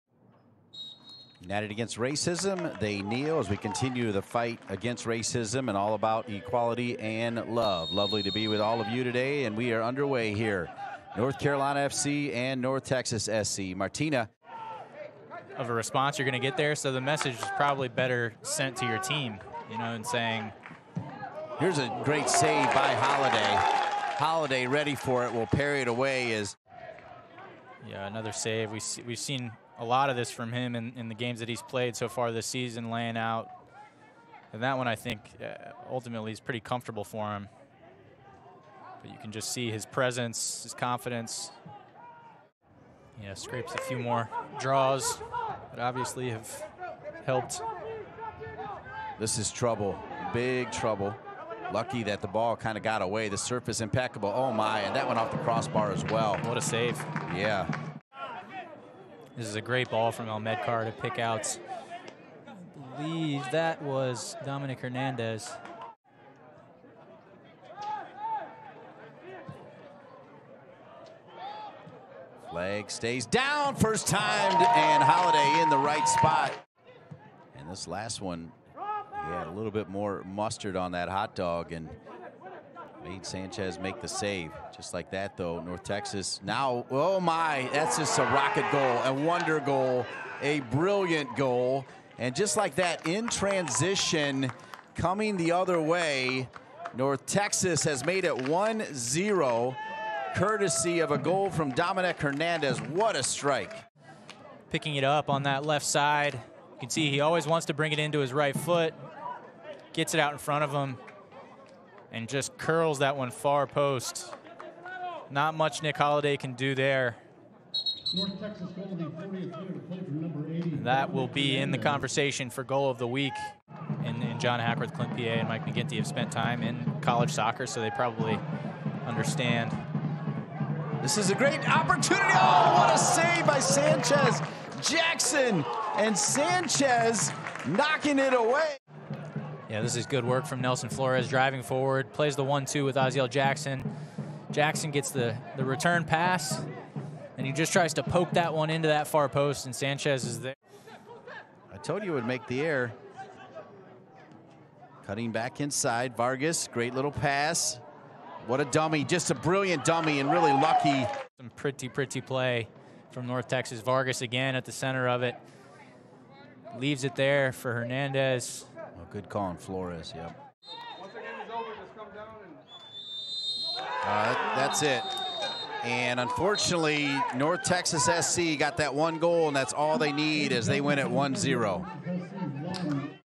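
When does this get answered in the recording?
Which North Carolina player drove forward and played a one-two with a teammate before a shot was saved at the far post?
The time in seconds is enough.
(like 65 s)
140 s.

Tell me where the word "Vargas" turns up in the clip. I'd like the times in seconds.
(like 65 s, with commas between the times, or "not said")
156 s, 163 s.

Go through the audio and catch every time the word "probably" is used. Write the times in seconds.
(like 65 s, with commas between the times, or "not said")
17 s, 127 s.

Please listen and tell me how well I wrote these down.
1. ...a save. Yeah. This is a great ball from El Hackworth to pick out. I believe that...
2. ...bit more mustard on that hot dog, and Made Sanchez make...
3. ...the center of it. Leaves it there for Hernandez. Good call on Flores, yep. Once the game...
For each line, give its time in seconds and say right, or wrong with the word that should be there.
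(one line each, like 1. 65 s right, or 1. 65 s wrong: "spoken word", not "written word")
1. 56 s wrong: "Medcar", not "Hackworth"
2. 79 s right
3. 164 s right.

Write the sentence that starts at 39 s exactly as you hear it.
But you can just see his presence, his confidence.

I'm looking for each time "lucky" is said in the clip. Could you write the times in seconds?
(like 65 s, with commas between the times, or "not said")
51 s, 160 s.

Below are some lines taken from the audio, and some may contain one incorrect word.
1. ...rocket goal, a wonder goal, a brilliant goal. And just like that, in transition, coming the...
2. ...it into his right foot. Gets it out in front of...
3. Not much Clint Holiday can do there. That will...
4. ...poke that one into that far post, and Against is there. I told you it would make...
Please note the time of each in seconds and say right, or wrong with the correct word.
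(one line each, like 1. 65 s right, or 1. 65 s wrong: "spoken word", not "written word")
1. 88 s right
2. 107 s right
3. 115 s wrong: "Nick", not "Clint"
4. 148 s wrong: "Sanchez", not "Against".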